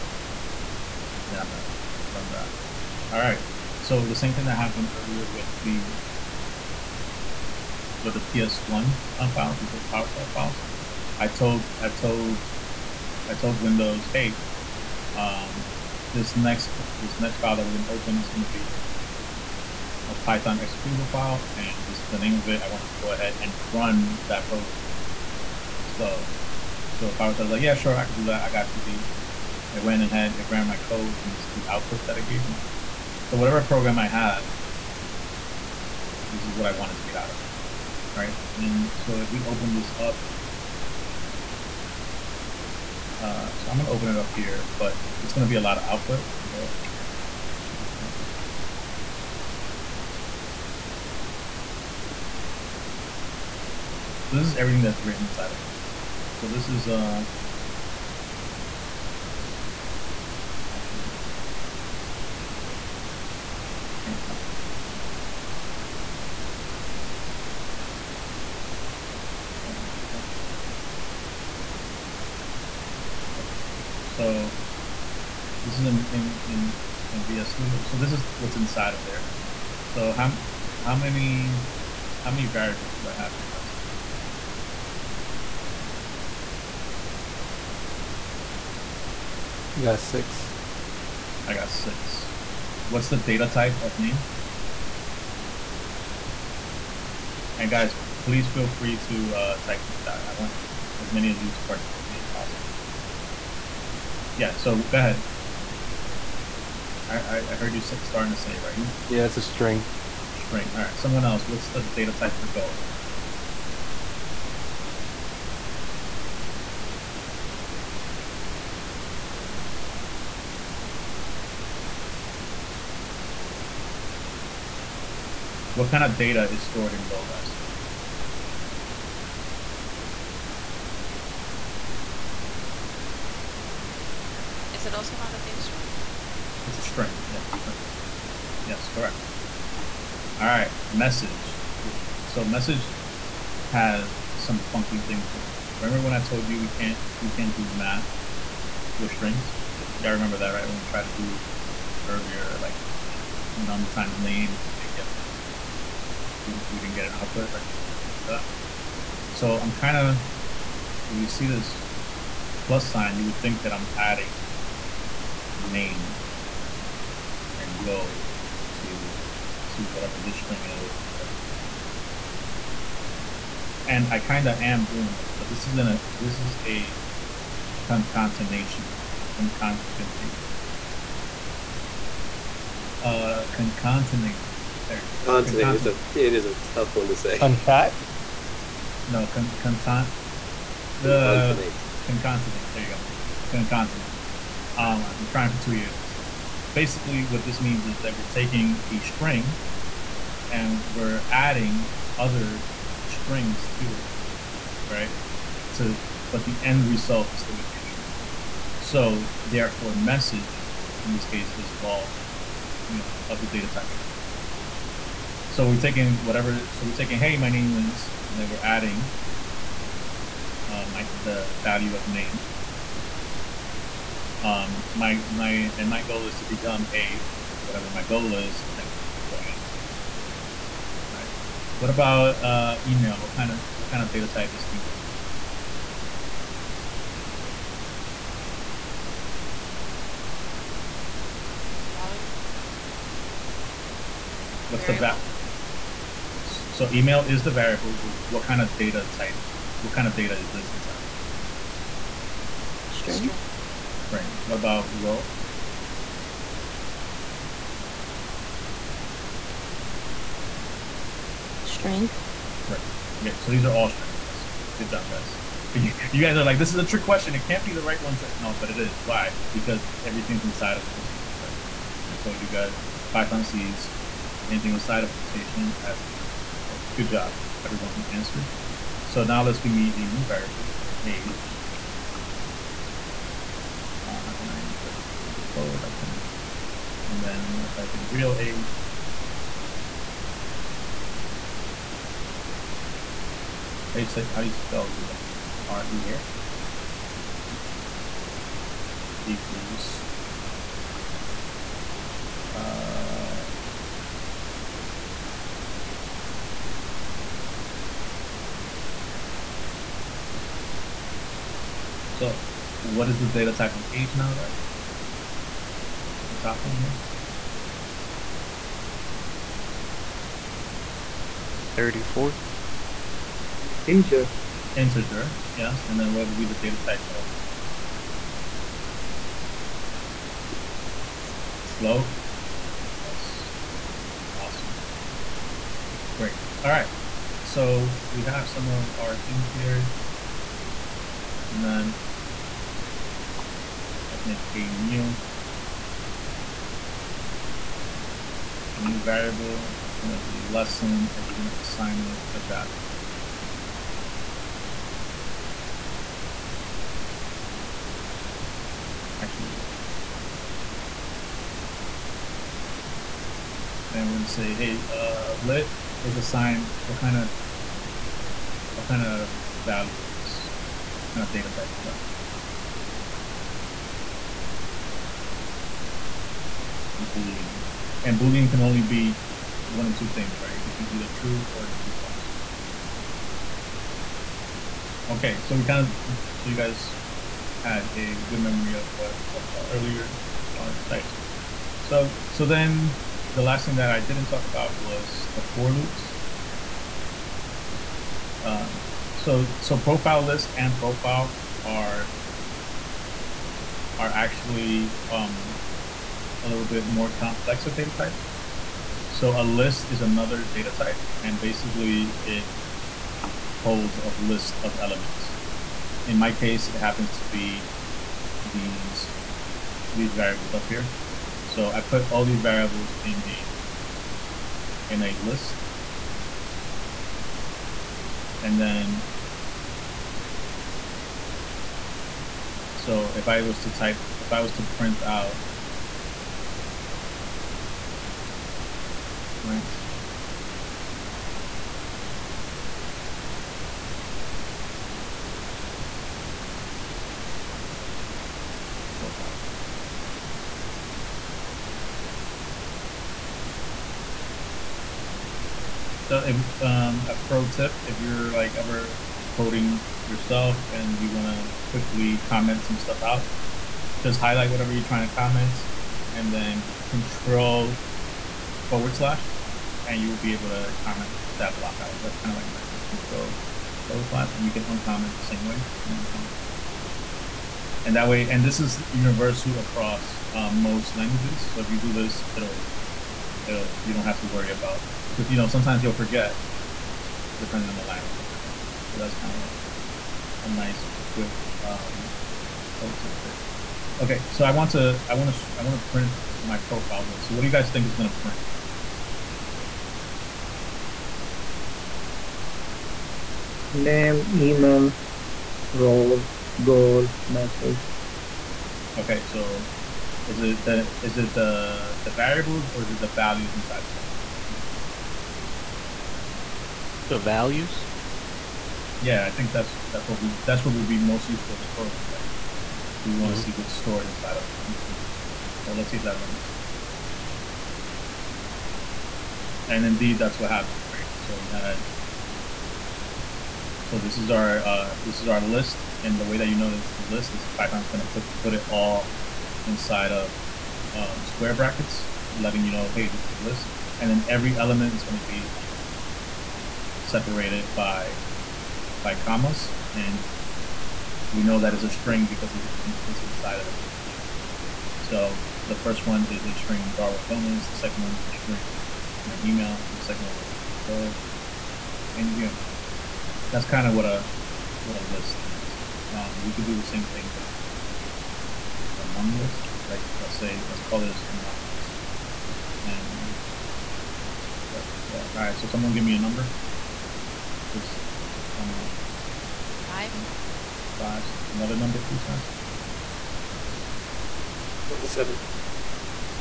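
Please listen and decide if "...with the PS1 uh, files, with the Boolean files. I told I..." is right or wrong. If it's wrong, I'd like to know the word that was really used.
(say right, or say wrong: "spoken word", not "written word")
wrong: "PowerShell", not "Boolean".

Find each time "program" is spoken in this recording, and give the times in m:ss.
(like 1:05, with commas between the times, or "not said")
0:24, 0:33, 8:41.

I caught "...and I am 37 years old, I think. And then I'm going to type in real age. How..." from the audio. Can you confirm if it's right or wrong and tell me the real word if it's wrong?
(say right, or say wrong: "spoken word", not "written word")
wrong: "34", not "37".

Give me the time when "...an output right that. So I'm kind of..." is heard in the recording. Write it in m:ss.
2:37.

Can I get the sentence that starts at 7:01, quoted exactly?
So I put all these variables in a, in a list.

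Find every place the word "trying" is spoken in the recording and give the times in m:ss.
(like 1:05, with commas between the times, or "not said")
3:15, 7:44.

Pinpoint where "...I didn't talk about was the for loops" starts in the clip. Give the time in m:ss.
6:33.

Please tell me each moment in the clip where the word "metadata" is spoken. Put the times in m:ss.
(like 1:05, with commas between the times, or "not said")
not said.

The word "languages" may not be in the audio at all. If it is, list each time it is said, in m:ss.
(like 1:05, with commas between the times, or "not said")
8:00, 8:07.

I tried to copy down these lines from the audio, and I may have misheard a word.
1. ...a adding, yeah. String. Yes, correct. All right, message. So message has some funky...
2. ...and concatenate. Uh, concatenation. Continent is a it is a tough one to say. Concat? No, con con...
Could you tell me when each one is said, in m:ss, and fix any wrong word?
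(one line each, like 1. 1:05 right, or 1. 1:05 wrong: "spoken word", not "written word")
1. 2:16 wrong: "string", not "adding"
2. 2:59 right.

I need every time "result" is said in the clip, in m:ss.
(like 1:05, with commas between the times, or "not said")
3:26.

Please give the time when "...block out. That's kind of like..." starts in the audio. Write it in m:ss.
7:51.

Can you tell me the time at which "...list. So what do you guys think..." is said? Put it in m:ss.
8:17.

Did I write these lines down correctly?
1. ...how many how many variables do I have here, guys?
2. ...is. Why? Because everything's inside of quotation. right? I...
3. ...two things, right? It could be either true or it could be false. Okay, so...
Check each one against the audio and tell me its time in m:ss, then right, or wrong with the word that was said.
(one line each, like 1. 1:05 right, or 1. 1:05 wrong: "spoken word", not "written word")
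1. 1:20 right
2. 4:28 right
3. 6:19 right.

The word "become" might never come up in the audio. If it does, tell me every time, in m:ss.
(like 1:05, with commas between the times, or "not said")
3:46.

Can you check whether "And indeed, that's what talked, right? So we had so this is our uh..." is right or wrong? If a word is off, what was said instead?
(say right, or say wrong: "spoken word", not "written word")
wrong: "happened", not "talked".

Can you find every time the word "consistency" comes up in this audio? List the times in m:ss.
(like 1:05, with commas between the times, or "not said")
not said.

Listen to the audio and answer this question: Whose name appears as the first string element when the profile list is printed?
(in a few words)
Darwin Gomez.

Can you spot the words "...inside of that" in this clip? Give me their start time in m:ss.
8:33.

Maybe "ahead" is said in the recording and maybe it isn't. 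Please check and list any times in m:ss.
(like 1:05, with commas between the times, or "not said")
0:23, 0:30, 1:44.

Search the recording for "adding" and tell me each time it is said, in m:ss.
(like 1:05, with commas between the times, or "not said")
2:43, 3:21, 3:38, 3:51.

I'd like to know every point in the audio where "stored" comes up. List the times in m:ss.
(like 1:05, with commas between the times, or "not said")
2:06, 8:43.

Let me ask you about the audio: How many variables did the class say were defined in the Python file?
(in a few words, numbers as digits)
6.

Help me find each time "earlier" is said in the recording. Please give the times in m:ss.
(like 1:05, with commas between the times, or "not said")
0:04, 2:32, 6:29.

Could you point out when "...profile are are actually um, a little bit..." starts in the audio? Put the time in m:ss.
6:40.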